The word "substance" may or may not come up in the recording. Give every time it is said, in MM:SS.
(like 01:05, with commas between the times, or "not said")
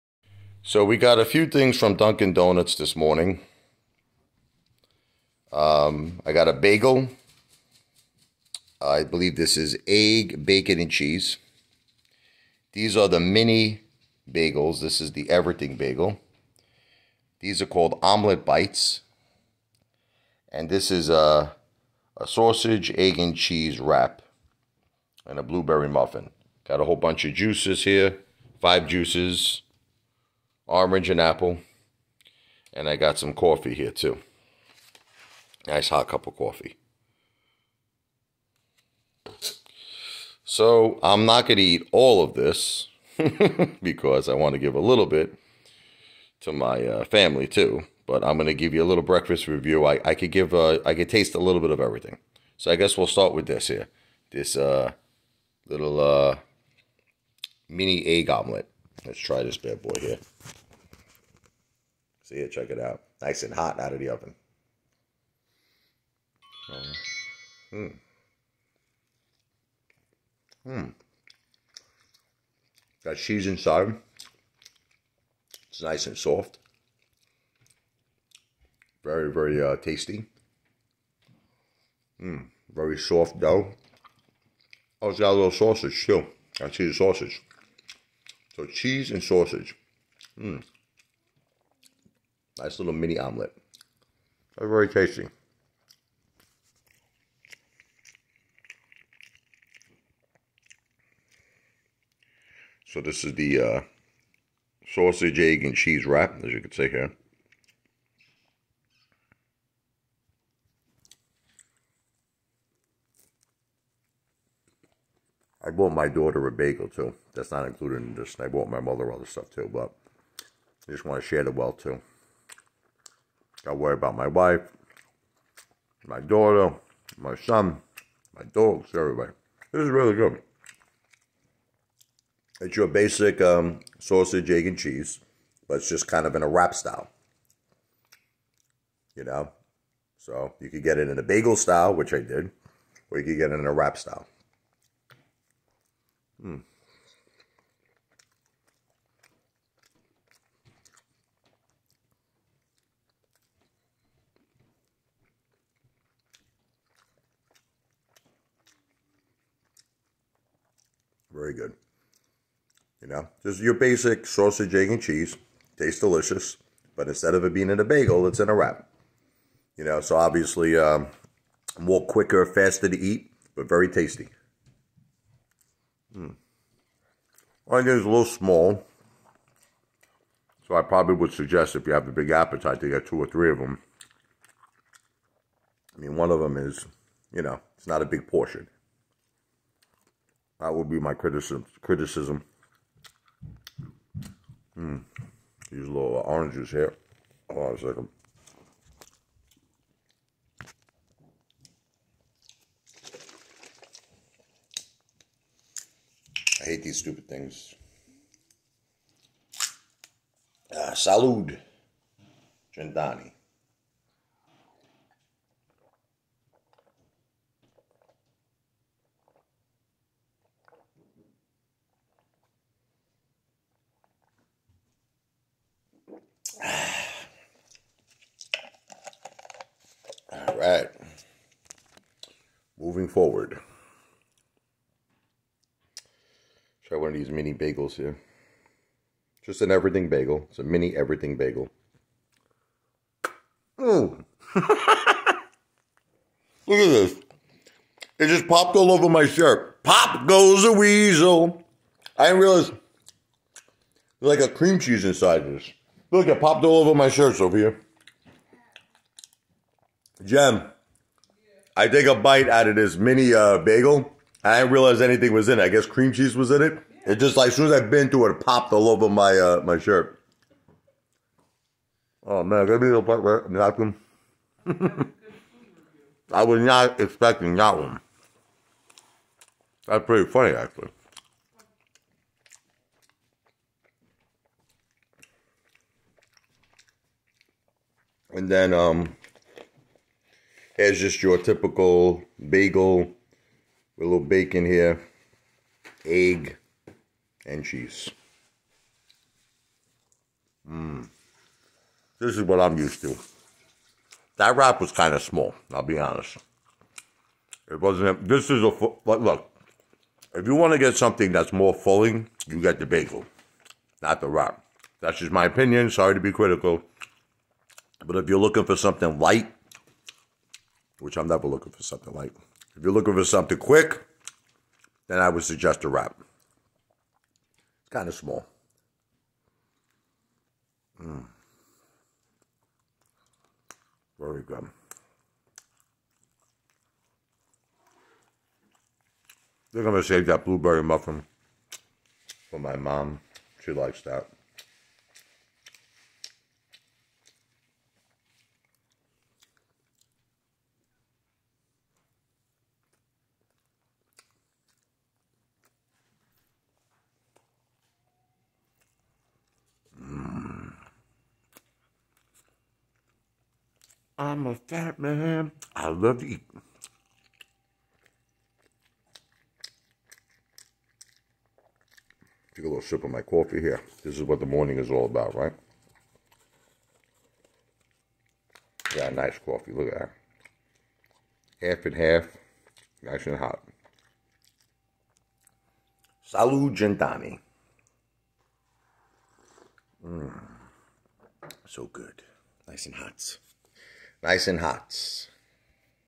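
not said.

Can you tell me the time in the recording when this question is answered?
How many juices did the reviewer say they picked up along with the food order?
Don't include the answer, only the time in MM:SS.
00:28.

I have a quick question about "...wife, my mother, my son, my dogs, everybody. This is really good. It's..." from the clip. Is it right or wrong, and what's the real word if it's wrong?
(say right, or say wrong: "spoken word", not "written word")
wrong: "daughter", not "mother".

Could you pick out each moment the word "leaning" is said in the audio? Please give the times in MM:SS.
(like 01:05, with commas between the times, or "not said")
not said.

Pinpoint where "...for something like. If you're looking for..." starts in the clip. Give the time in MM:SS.
05:21.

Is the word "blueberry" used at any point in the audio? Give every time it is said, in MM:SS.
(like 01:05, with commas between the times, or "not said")
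00:25, 05:40.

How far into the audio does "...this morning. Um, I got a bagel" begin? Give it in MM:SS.
00:02.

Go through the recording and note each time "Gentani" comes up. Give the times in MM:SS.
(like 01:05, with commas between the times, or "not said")
03:32, 06:26.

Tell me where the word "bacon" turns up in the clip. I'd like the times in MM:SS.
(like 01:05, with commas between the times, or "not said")
00:10, 04:54.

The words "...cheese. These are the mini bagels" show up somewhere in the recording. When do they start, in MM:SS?
00:10.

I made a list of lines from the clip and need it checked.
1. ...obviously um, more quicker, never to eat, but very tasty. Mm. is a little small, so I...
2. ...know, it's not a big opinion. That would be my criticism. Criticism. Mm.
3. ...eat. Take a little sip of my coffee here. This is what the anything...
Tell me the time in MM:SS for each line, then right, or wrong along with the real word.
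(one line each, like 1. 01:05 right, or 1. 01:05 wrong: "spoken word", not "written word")
1. 02:50 wrong: "faster", not "never"
2. 03:07 wrong: "portion", not "opinion"
3. 06:06 wrong: "morning", not "anything".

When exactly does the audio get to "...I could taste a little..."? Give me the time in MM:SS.
00:50.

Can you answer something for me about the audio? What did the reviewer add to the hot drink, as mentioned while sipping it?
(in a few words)
Half and half.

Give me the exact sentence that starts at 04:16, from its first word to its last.
Look, it popped all over my shirt, Sophia.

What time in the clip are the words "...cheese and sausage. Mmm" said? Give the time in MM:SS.
01:28.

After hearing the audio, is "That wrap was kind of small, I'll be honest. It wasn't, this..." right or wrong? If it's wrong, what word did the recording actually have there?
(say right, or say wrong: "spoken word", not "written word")
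right.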